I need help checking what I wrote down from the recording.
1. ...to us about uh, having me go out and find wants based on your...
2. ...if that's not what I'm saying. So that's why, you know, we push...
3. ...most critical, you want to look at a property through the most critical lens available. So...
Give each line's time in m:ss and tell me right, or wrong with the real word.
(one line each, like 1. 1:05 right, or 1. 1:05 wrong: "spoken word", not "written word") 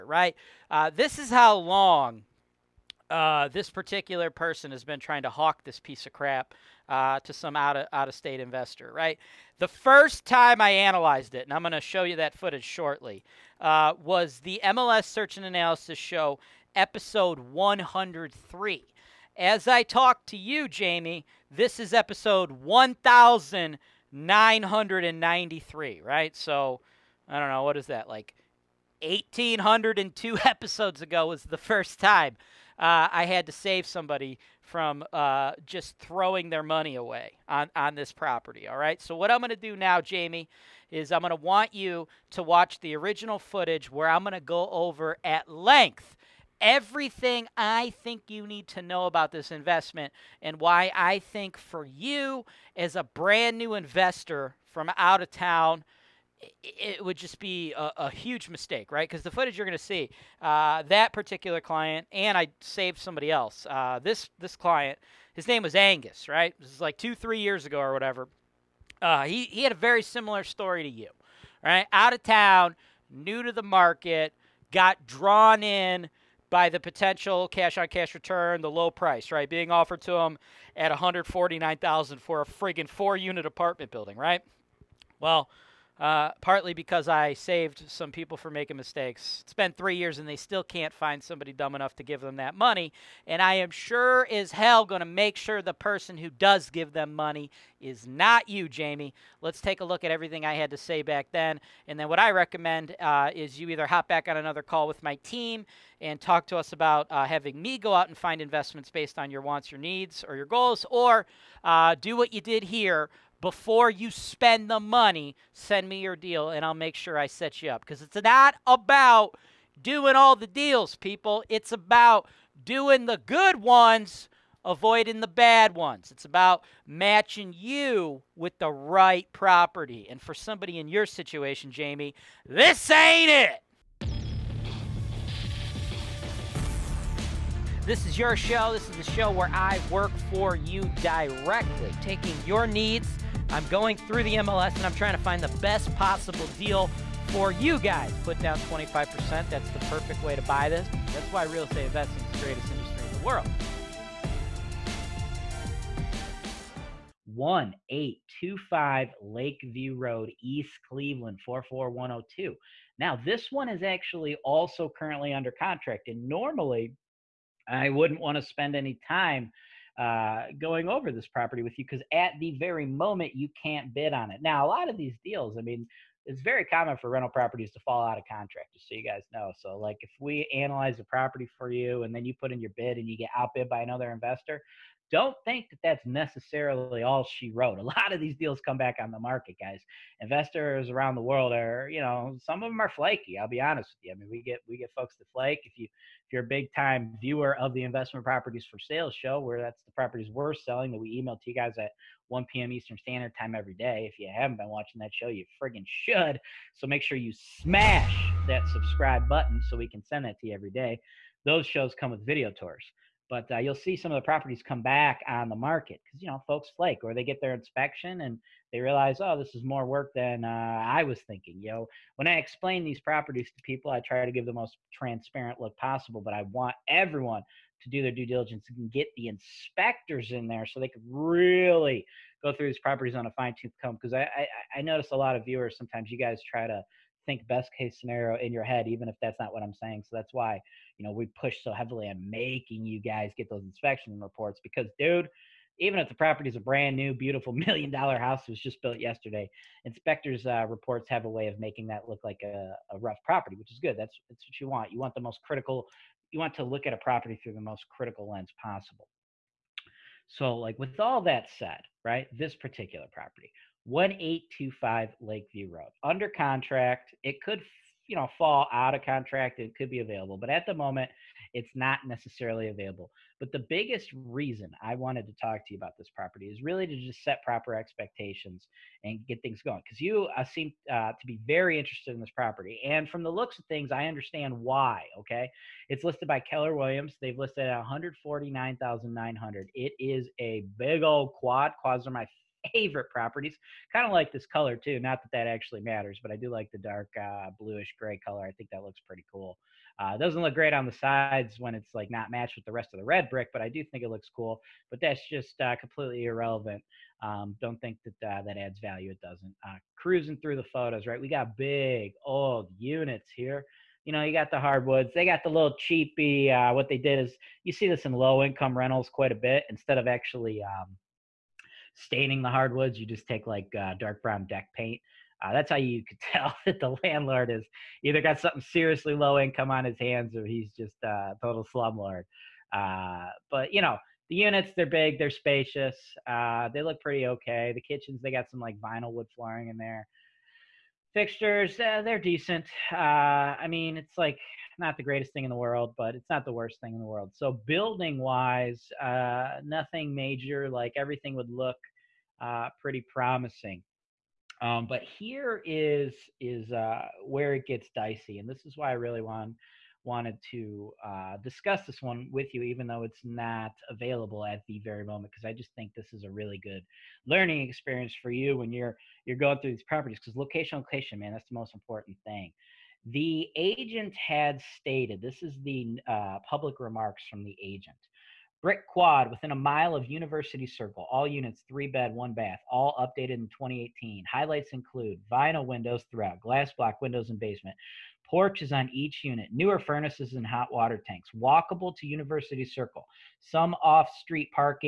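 1. 1:46 wrong: "investments", not "wants"
2. 3:59 right
3. 4:15 wrong: "possible", not "available".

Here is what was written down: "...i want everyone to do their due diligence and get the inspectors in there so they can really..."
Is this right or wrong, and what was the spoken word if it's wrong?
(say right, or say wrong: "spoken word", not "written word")
right.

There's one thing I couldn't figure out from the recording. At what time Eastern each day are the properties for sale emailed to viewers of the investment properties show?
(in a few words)
1 p.m.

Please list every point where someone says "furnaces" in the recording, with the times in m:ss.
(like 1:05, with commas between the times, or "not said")
6:29.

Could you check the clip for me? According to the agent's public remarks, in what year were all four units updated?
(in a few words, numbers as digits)
2018.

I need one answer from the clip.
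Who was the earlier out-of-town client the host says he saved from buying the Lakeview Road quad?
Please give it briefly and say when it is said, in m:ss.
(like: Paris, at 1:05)
Angus, at 1:05.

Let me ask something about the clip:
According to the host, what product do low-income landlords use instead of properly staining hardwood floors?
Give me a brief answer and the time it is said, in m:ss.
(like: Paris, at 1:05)
dark brown deck paint, at 5:23.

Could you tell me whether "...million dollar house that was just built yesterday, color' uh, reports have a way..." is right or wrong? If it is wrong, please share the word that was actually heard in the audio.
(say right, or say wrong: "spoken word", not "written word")
wrong: "inspectors", not "color".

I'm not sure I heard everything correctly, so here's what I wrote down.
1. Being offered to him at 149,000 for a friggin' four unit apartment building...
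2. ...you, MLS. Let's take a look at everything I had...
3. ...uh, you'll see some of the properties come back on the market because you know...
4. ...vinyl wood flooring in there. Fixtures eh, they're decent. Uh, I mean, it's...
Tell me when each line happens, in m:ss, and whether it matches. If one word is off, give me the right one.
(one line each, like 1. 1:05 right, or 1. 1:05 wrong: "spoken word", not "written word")
1. 1:19 right
2. 1:38 wrong: "Jamie", not "MLS"
3. 3:33 right
4. 5:38 right.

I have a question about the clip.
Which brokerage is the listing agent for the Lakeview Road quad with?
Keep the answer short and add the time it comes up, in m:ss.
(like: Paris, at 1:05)
Keller Williams, at 4:46.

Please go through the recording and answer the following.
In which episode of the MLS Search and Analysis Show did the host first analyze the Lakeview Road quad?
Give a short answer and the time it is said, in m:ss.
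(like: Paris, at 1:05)
103, at 0:16.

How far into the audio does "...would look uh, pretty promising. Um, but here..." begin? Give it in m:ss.
5:51.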